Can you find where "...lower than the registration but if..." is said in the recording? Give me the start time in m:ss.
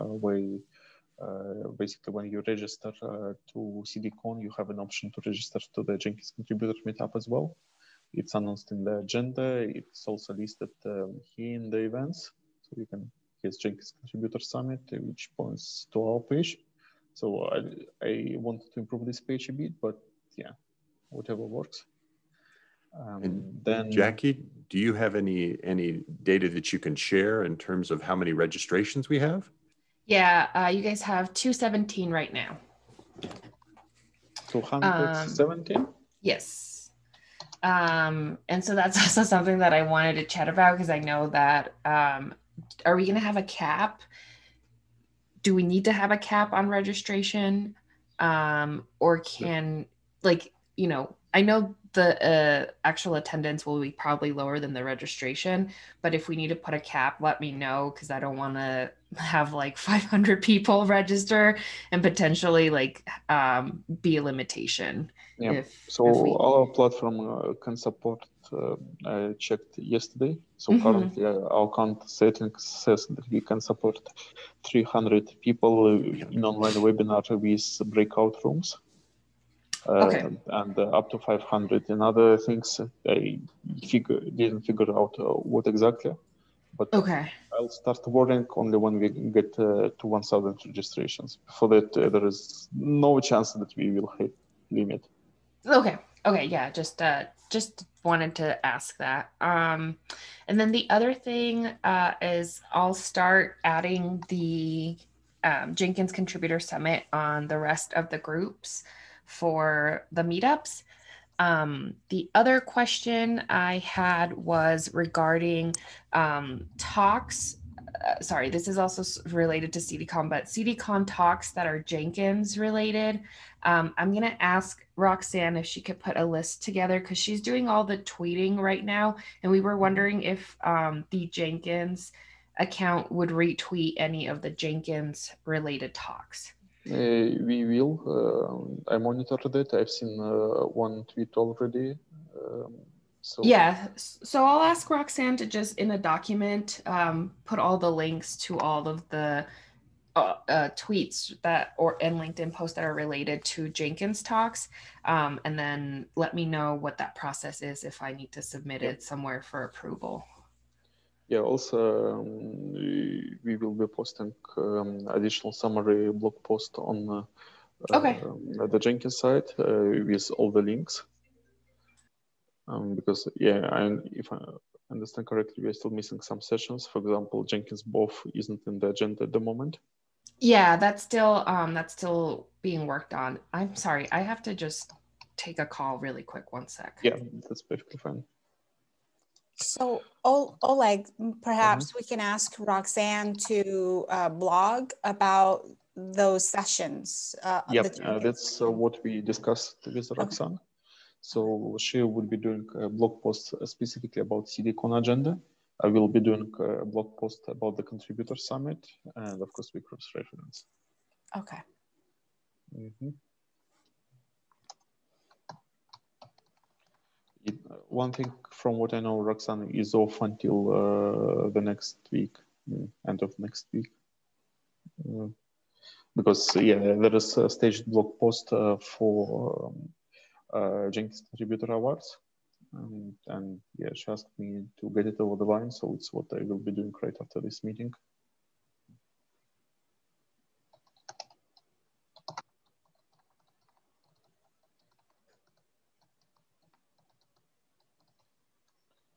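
0:54.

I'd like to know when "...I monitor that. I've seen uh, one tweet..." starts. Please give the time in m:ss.
2:18.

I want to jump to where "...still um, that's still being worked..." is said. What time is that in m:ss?
3:01.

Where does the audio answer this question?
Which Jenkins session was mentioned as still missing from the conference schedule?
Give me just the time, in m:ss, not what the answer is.
2:57.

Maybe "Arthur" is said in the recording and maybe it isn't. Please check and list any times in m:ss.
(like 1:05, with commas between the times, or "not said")
not said.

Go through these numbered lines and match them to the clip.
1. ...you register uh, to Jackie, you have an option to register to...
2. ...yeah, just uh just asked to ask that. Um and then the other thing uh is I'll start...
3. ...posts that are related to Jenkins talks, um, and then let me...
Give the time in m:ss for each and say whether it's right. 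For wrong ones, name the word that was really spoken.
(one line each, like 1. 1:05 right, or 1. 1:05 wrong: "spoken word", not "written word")
1. 0:02 wrong: "CDCon", not "Jackie"
2. 1:36 wrong: "wanted", not "asked"
3. 2:32 right.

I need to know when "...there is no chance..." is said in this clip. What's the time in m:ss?
1:31.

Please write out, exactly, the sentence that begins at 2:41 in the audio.
Yeah, also um, we will be posting um, additional summary blog post on uh, okay.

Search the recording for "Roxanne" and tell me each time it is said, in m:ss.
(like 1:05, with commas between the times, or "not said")
2:04, 2:24, 3:12, 3:20, 3:39.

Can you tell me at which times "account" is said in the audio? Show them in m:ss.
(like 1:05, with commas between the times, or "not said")
1:11, 2:12.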